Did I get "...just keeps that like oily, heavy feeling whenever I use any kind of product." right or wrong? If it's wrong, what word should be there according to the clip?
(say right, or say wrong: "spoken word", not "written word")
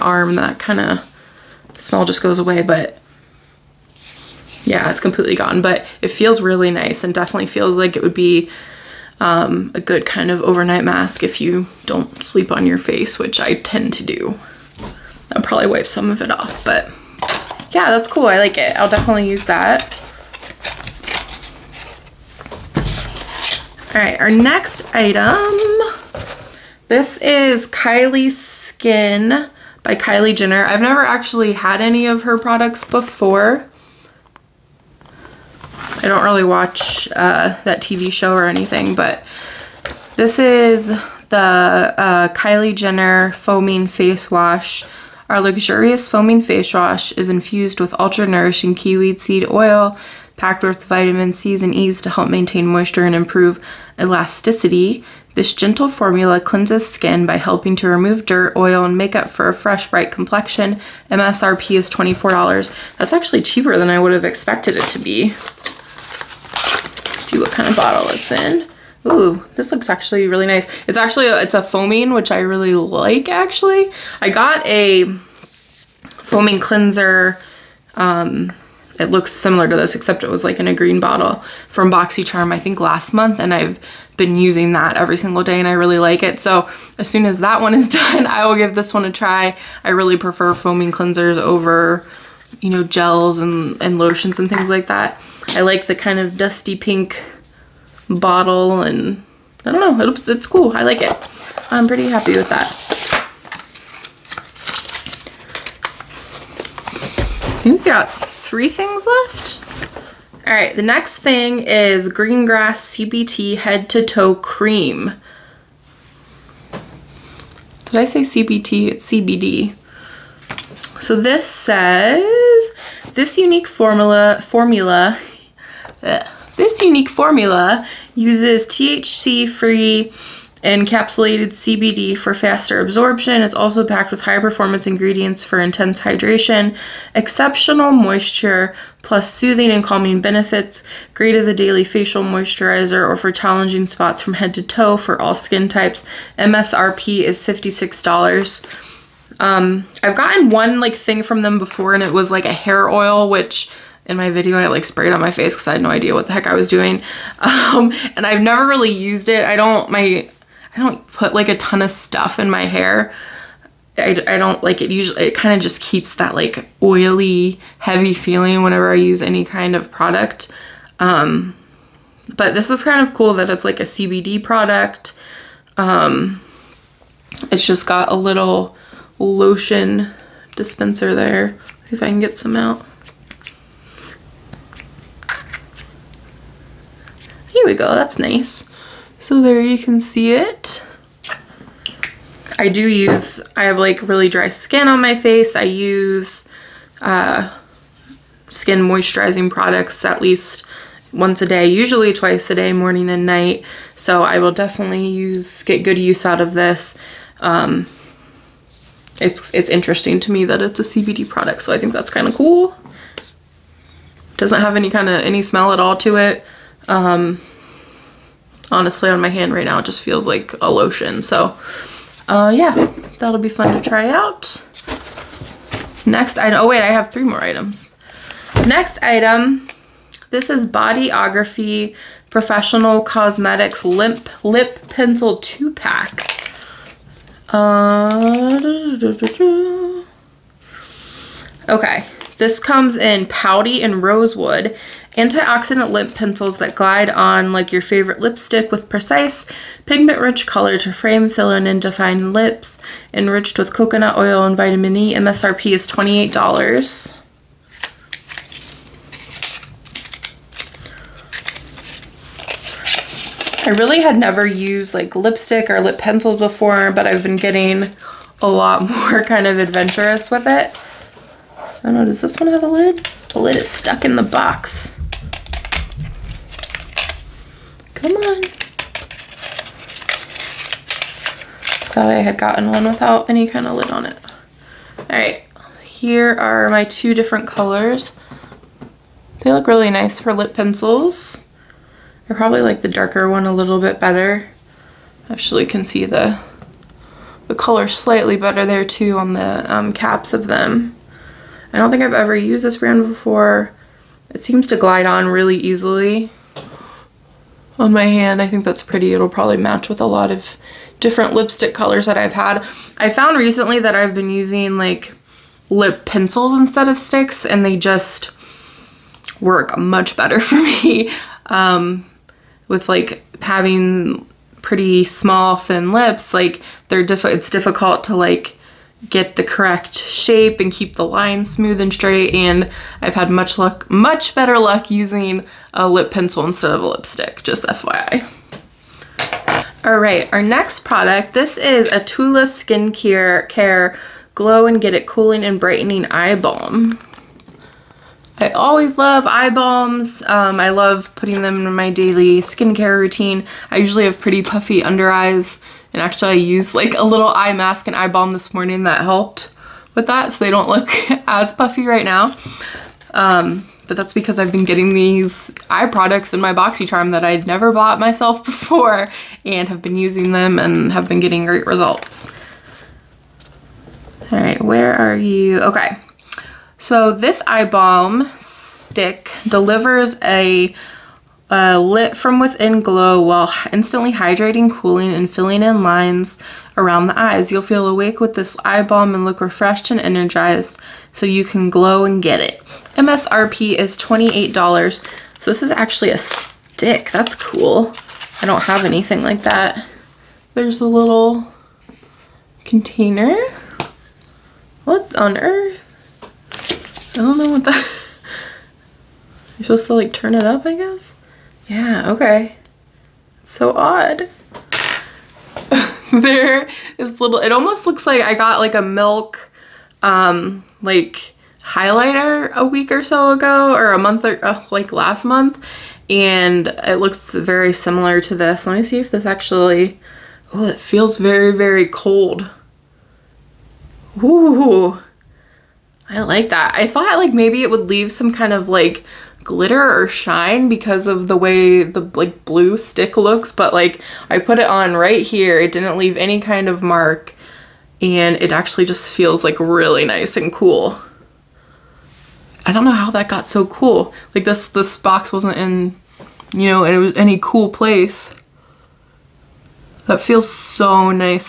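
right.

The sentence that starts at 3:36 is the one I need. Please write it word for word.
Um, honestly, on my hand right now, it just feels like a lotion.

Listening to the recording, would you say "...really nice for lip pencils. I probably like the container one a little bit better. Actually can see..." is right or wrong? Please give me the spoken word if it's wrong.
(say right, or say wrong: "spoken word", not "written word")
wrong: "darker", not "container".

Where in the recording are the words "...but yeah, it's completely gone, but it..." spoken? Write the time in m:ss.
0:02.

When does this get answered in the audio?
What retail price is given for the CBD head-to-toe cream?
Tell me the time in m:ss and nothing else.
2:27.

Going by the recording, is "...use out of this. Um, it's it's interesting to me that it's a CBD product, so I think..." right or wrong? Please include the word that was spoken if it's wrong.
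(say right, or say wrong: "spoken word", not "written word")
right.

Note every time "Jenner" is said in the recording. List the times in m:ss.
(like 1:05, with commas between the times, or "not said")
0:30, 0:42.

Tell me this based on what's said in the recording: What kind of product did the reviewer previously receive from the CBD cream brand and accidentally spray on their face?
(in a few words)
hair oil.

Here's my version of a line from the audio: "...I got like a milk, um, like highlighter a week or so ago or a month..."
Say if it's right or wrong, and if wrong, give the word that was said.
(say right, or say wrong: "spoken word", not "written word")
right.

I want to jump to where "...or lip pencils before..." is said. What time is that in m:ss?
4:25.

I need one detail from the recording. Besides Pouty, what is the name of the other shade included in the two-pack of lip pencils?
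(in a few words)
Rosewood.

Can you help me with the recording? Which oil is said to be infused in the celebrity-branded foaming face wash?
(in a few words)
kiwi seed oil.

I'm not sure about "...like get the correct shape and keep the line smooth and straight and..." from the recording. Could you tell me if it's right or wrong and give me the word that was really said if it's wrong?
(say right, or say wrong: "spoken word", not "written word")
right.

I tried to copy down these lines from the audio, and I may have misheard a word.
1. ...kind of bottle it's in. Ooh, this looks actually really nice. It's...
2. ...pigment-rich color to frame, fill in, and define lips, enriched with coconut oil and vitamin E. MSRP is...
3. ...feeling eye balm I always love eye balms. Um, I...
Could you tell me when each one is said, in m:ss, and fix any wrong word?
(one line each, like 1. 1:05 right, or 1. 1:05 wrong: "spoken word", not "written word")
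1. 1:07 right
2. 4:09 right
3. 5:45 wrong: "brightening", not "feeling".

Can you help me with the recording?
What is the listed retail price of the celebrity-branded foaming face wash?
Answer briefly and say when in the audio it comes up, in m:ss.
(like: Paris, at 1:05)
$24, at 1:01.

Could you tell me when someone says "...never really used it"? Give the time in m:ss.
2:38.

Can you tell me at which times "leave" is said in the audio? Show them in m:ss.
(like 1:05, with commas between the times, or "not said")
7:17, 7:25.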